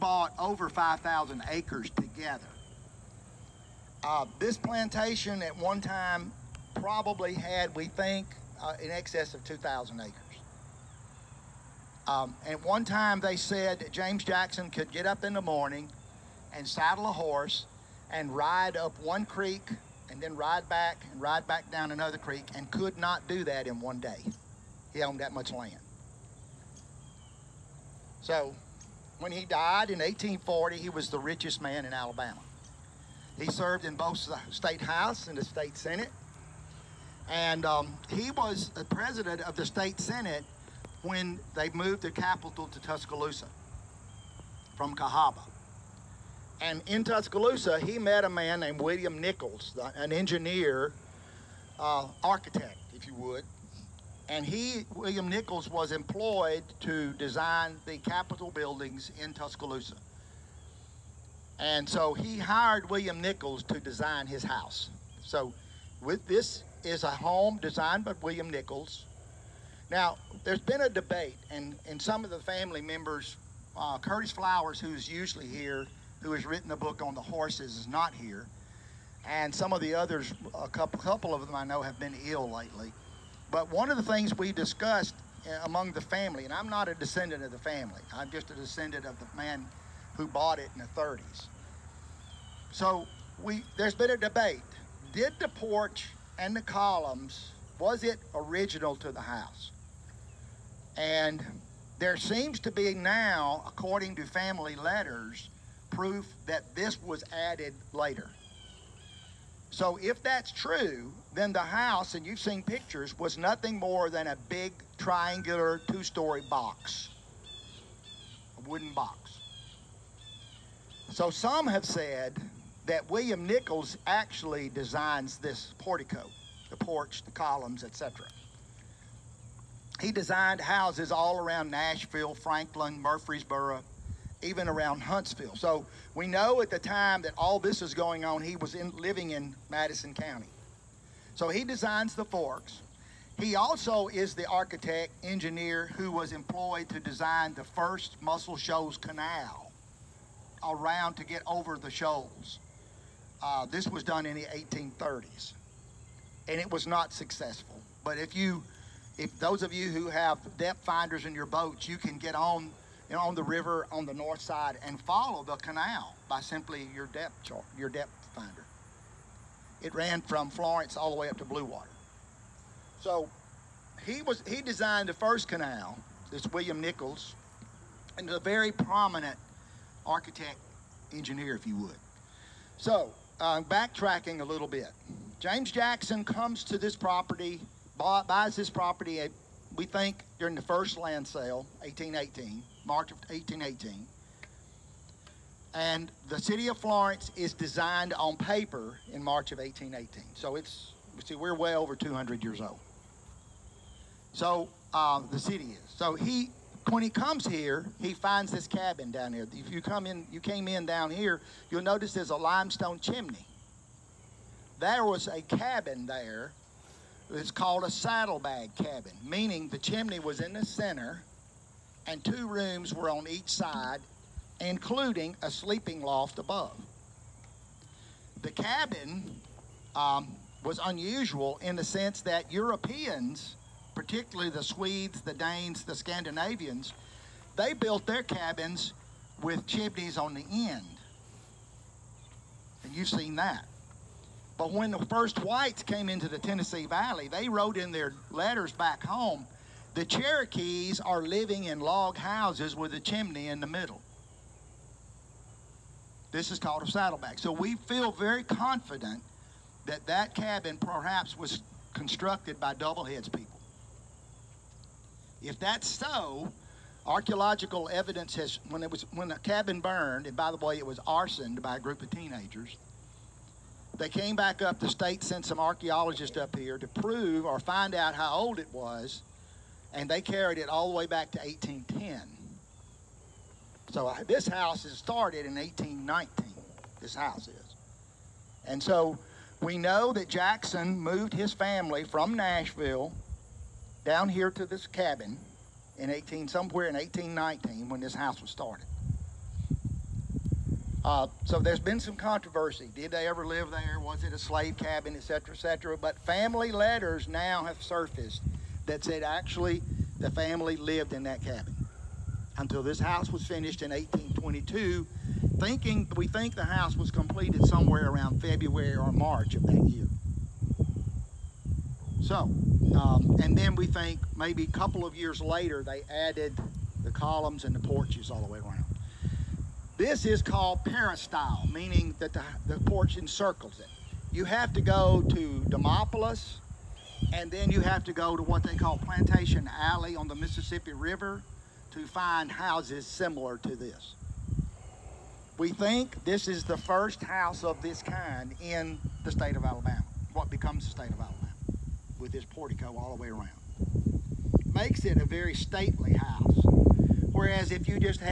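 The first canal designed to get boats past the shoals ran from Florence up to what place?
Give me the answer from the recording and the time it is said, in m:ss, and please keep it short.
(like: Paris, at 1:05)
Blue Water, at 2:51.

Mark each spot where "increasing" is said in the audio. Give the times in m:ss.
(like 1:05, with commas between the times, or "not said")
not said.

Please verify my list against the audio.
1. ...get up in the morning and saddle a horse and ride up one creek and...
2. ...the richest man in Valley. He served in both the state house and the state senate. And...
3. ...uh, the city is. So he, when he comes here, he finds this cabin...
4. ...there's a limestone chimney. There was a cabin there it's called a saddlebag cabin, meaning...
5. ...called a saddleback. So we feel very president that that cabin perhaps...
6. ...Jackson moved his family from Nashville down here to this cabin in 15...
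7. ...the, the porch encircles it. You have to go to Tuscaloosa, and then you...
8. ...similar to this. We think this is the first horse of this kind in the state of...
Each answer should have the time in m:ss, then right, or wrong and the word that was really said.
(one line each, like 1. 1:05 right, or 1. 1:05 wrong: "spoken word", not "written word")
1. 0:14 right
2. 0:31 wrong: "Alabama", not "Valley"
3. 3:24 right
4. 3:32 right
5. 4:16 wrong: "confident", not "president"
6. 4:50 wrong: "18", not "15"
7. 5:32 wrong: "Demopolis", not "Tuscaloosa"
8. 5:43 wrong: "house", not "horse".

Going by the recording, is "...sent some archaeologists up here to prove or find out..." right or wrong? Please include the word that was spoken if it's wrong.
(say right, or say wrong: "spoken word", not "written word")
right.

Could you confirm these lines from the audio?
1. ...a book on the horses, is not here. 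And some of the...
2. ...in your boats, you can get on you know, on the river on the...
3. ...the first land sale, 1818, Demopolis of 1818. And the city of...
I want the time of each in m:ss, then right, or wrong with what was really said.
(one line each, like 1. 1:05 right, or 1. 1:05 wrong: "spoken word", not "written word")
1. 1:16 right
2. 2:41 right
3. 3:10 wrong: "March", not "Demopolis".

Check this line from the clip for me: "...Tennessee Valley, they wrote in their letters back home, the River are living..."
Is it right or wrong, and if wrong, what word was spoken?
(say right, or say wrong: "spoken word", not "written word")
wrong: "Cherokees", not "River".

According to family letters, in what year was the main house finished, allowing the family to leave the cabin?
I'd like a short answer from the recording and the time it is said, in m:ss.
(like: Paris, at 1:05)
1822, at 5:13.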